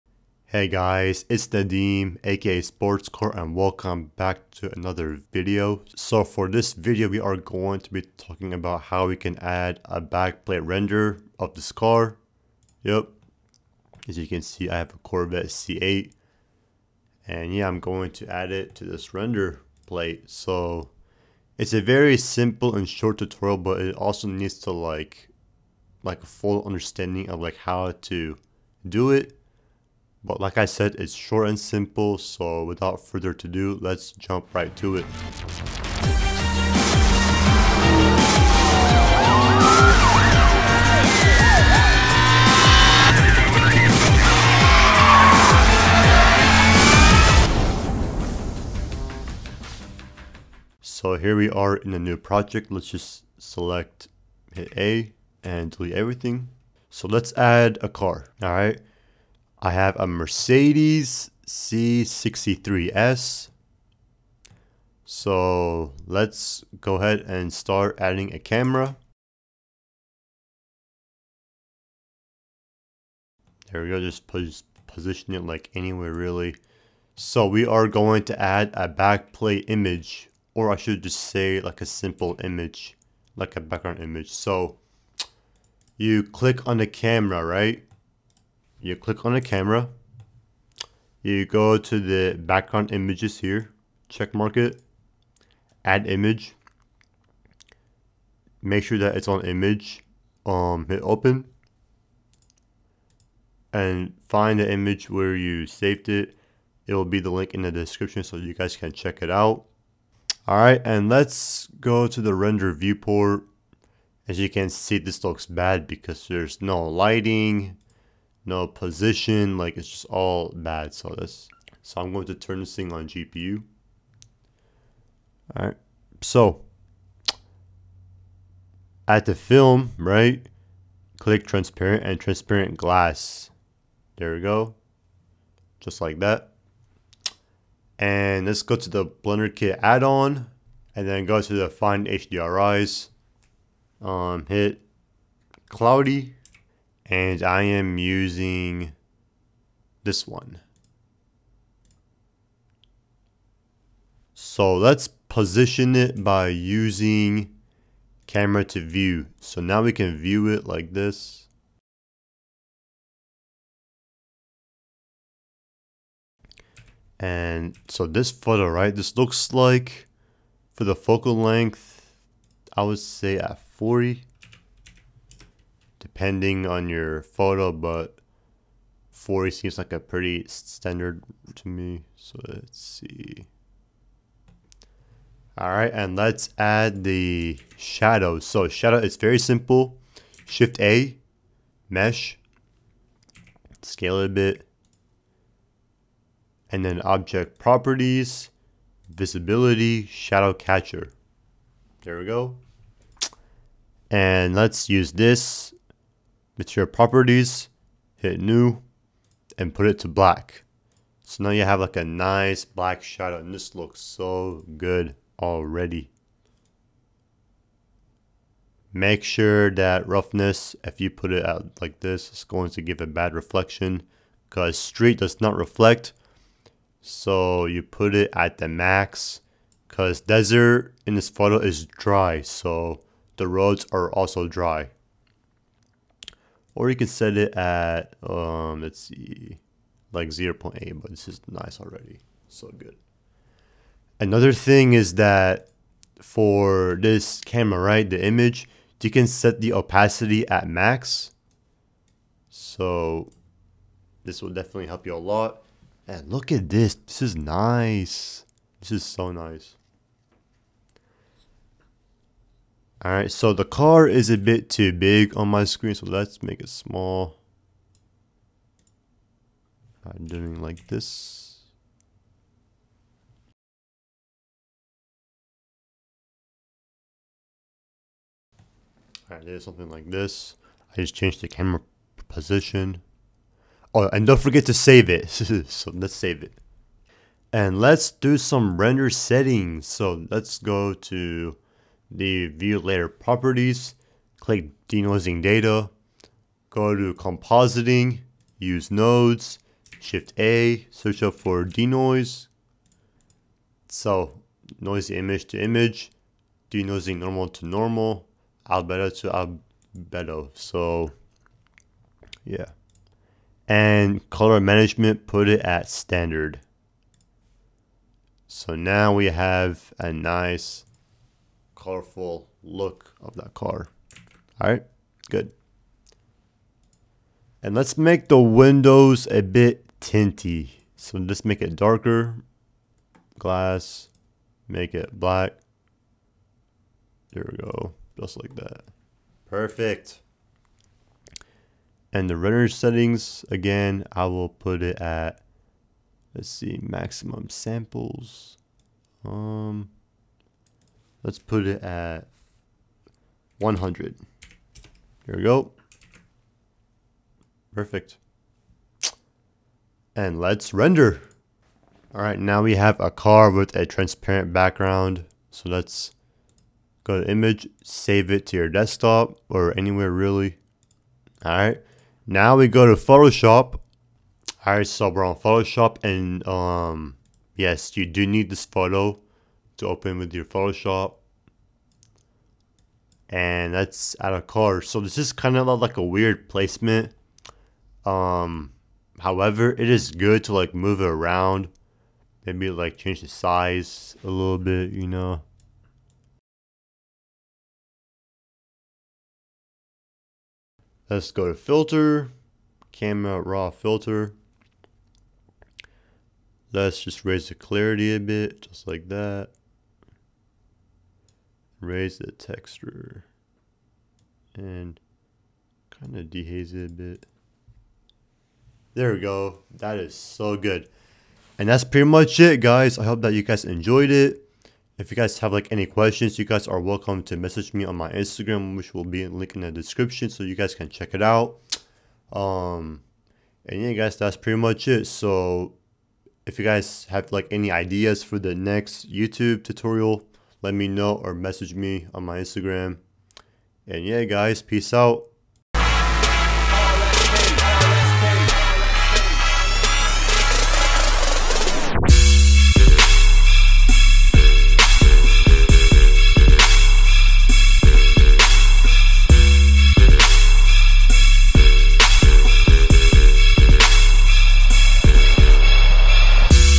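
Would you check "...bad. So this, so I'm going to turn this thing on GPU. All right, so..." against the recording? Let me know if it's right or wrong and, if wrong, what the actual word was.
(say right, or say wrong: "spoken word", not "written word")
right.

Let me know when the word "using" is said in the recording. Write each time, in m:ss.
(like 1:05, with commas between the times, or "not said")
2:27, 2:36.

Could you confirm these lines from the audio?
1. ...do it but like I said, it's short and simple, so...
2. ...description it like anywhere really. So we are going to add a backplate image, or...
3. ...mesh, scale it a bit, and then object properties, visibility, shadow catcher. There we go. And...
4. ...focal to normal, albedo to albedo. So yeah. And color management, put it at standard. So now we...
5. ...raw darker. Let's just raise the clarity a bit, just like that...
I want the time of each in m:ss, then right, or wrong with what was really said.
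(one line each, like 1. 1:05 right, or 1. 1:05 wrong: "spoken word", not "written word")
1. 0:28 right
2. 1:14 wrong: "position", not "description"
3. 3:11 right
4. 5:07 wrong: "normal", not "focal"
5. 6:43 wrong: "filter", not "darker".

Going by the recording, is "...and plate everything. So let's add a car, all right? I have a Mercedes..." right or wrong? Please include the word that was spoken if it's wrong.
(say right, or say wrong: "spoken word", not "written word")
wrong: "delete", not "plate".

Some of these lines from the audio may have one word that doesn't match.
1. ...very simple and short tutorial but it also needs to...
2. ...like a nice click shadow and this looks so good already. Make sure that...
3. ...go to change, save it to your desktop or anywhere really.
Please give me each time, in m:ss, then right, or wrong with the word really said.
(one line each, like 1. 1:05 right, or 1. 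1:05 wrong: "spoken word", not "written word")
1. 0:21 right
2. 3:31 wrong: "black", not "click"
3. 6:07 wrong: "image", not "change".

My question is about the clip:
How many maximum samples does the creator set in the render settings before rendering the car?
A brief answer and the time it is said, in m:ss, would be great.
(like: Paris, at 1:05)
100, at 5:53.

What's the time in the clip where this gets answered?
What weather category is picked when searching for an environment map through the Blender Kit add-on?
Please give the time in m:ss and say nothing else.
2:25.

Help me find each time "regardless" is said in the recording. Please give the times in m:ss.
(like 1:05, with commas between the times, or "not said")
not said.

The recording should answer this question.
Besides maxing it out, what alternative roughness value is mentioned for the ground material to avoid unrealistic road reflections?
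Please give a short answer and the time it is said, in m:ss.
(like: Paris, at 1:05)
0.8, at 4:00.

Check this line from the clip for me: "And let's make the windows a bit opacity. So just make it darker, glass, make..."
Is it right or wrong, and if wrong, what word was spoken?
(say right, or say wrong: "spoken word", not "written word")
wrong: "tinty", not "opacity".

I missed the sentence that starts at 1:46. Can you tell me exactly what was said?
It will be the link in the description so you guys can check it out.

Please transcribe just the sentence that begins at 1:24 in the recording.
So you click on the camera, right?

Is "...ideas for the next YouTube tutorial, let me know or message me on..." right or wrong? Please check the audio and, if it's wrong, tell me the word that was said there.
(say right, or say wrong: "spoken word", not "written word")
right.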